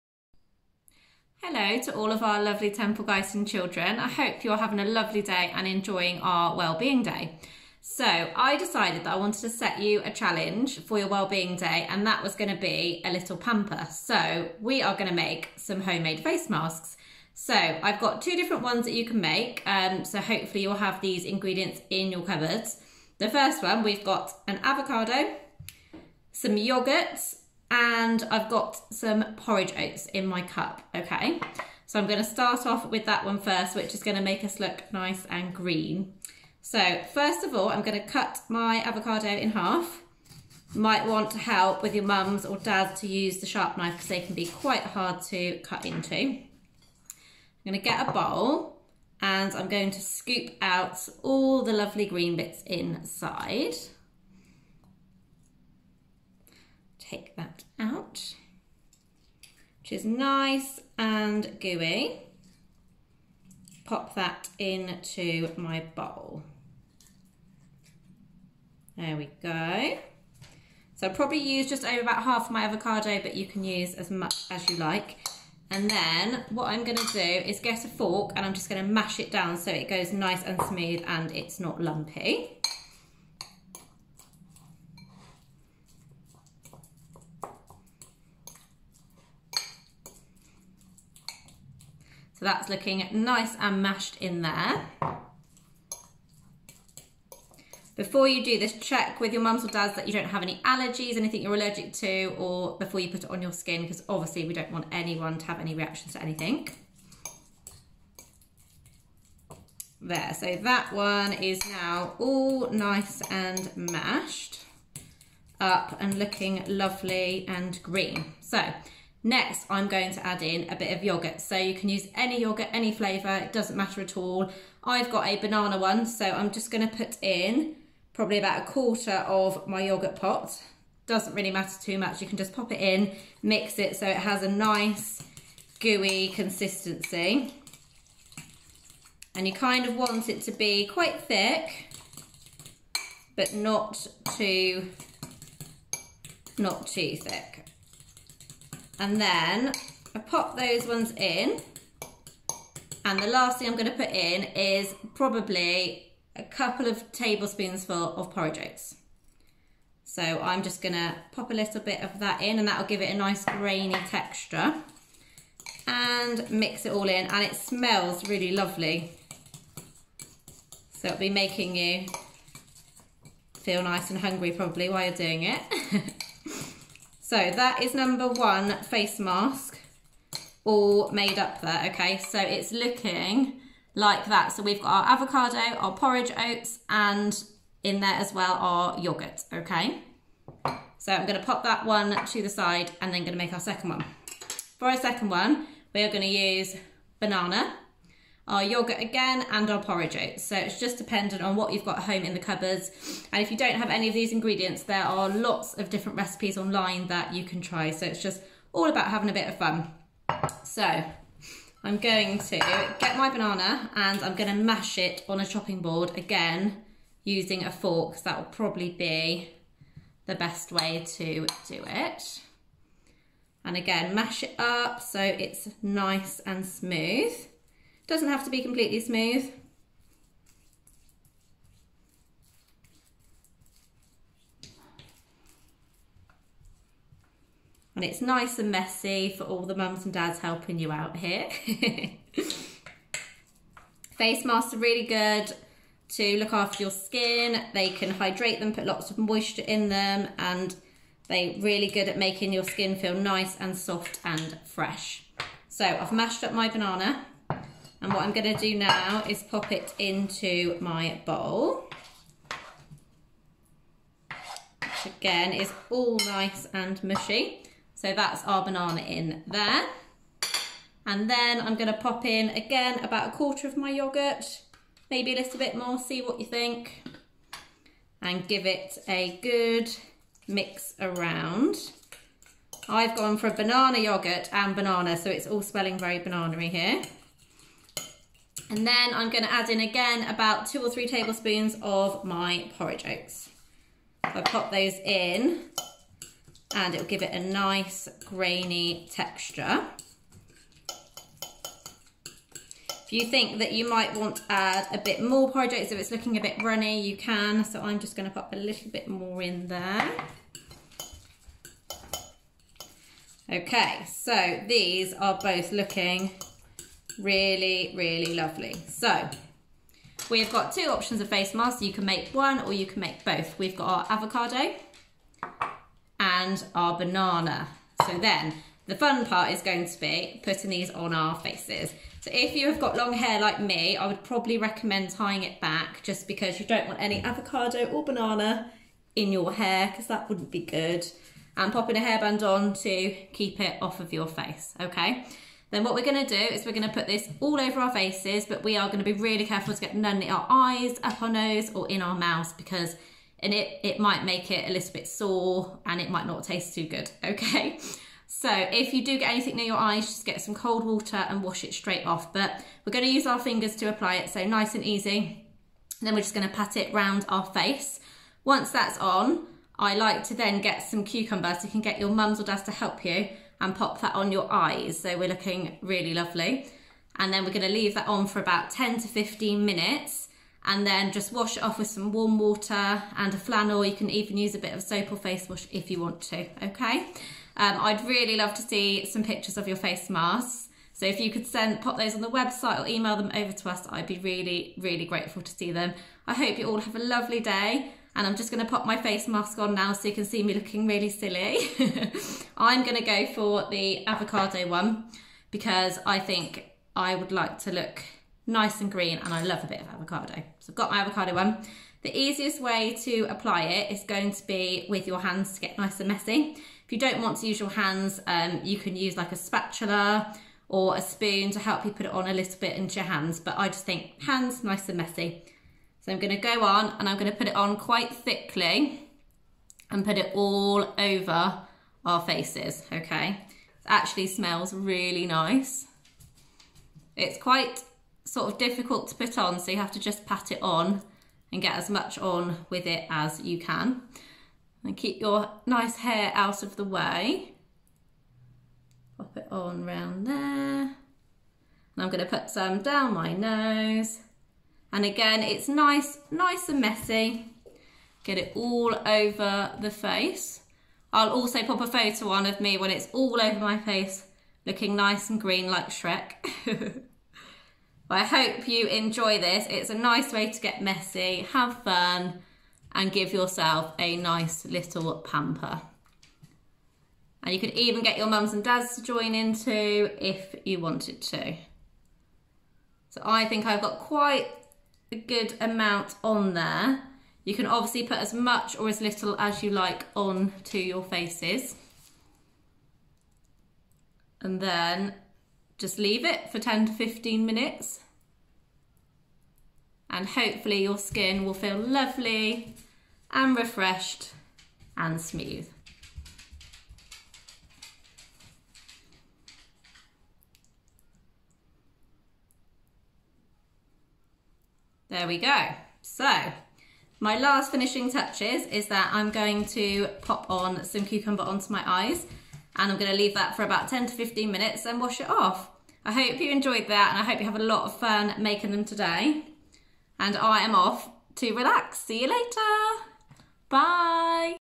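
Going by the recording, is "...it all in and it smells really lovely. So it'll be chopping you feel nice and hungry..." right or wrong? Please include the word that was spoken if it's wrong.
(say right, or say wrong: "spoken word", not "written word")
wrong: "making", not "chopping".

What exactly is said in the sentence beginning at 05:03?
If you think that you might want to add a bit more porridge oats, if it's looking a bit runny, you can.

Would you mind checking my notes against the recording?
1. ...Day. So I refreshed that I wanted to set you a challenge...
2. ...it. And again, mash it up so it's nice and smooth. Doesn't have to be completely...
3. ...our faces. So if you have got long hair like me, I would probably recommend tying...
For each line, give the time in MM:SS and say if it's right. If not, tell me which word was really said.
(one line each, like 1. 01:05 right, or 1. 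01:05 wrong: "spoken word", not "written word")
1. 00:07 wrong: "decided", not "refreshed"
2. 03:41 right
3. 05:31 right.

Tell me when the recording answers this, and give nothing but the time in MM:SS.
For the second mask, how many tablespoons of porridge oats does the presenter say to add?
04:50.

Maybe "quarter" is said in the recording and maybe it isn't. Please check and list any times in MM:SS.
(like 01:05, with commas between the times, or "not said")
02:08, 04:33.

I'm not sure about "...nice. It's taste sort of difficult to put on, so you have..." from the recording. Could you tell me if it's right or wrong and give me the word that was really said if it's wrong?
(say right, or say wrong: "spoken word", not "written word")
wrong: "quite", not "taste".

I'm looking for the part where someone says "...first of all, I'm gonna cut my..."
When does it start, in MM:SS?
00:37.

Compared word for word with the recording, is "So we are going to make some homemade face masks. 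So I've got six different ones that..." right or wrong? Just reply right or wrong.
wrong.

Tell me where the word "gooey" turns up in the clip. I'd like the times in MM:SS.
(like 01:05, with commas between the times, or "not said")
01:01, 02:15.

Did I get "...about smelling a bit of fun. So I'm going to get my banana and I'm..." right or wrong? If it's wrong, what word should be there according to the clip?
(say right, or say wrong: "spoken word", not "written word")
wrong: "having", not "smelling".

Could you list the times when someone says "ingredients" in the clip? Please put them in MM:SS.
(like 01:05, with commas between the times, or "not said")
00:21, 03:24.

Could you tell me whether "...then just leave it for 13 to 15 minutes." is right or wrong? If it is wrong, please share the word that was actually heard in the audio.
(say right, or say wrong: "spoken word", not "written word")
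wrong: "10", not "13".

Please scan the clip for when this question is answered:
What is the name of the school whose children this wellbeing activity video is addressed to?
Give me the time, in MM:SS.
00:02.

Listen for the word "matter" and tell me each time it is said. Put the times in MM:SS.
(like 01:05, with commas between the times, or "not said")
02:03, 02:11.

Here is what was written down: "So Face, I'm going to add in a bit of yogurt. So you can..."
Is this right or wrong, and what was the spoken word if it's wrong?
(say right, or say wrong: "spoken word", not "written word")
wrong: "Next", not "Face".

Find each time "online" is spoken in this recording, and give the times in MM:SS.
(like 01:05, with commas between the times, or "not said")
03:26.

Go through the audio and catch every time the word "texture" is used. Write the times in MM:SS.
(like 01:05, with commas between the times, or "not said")
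02:44, 04:59.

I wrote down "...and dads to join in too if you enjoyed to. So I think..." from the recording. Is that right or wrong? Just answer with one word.
wrong.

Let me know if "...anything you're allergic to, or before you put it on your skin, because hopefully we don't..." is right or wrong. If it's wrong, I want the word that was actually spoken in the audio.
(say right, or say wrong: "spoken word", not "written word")
wrong: "obviously", not "hopefully".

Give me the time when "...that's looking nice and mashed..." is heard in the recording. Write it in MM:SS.
01:32.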